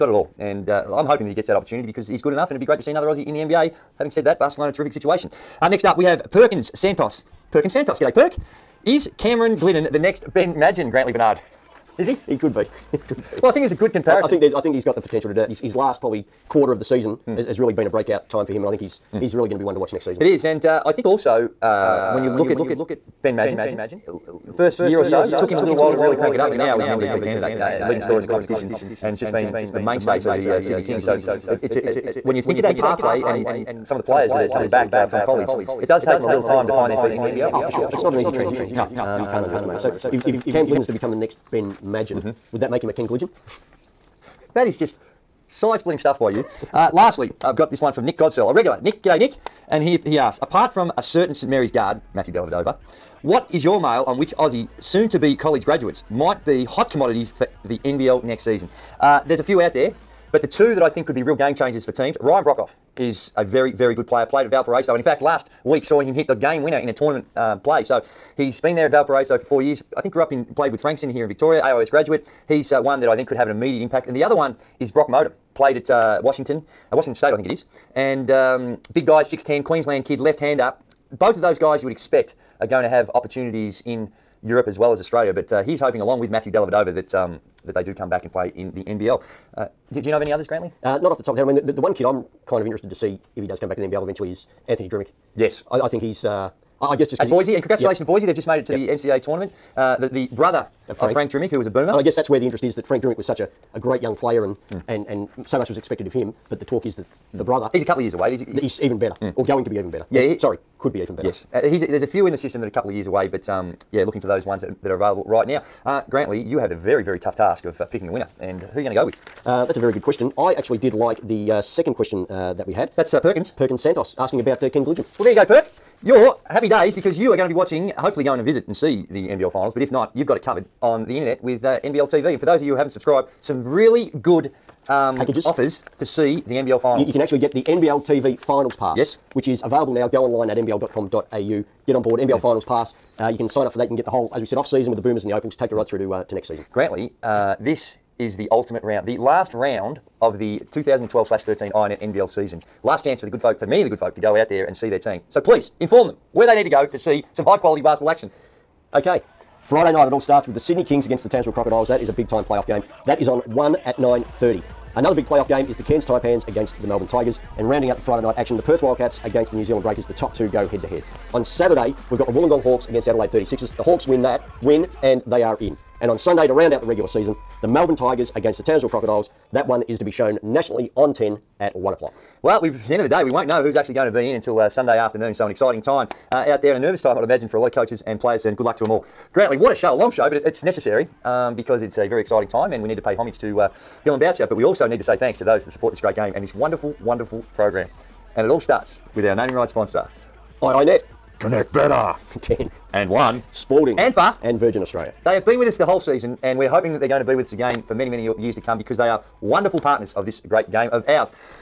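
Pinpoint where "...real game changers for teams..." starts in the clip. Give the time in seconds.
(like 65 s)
61 s.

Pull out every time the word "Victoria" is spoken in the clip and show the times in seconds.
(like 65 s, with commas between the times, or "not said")
71 s.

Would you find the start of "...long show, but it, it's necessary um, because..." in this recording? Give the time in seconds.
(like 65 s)
189 s.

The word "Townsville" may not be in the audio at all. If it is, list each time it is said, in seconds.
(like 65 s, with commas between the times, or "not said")
161 s, 178 s.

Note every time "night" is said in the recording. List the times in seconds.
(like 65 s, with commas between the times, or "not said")
159 s, 168 s.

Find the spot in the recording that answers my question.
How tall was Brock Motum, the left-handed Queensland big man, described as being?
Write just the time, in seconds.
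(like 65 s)
79 s.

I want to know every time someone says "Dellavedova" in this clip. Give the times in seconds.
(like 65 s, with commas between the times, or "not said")
52 s, 86 s.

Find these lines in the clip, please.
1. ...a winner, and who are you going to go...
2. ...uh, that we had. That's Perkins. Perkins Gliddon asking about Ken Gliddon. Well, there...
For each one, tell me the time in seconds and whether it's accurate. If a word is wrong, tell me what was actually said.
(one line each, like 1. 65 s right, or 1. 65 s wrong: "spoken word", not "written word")
1. 118 s right
2. 122 s wrong: "Santos", not "Gliddon".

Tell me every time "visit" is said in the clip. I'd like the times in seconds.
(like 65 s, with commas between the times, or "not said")
128 s.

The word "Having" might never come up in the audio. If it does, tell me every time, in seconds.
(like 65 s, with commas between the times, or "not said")
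3 s.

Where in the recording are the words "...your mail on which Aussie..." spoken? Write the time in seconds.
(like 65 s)
53 s.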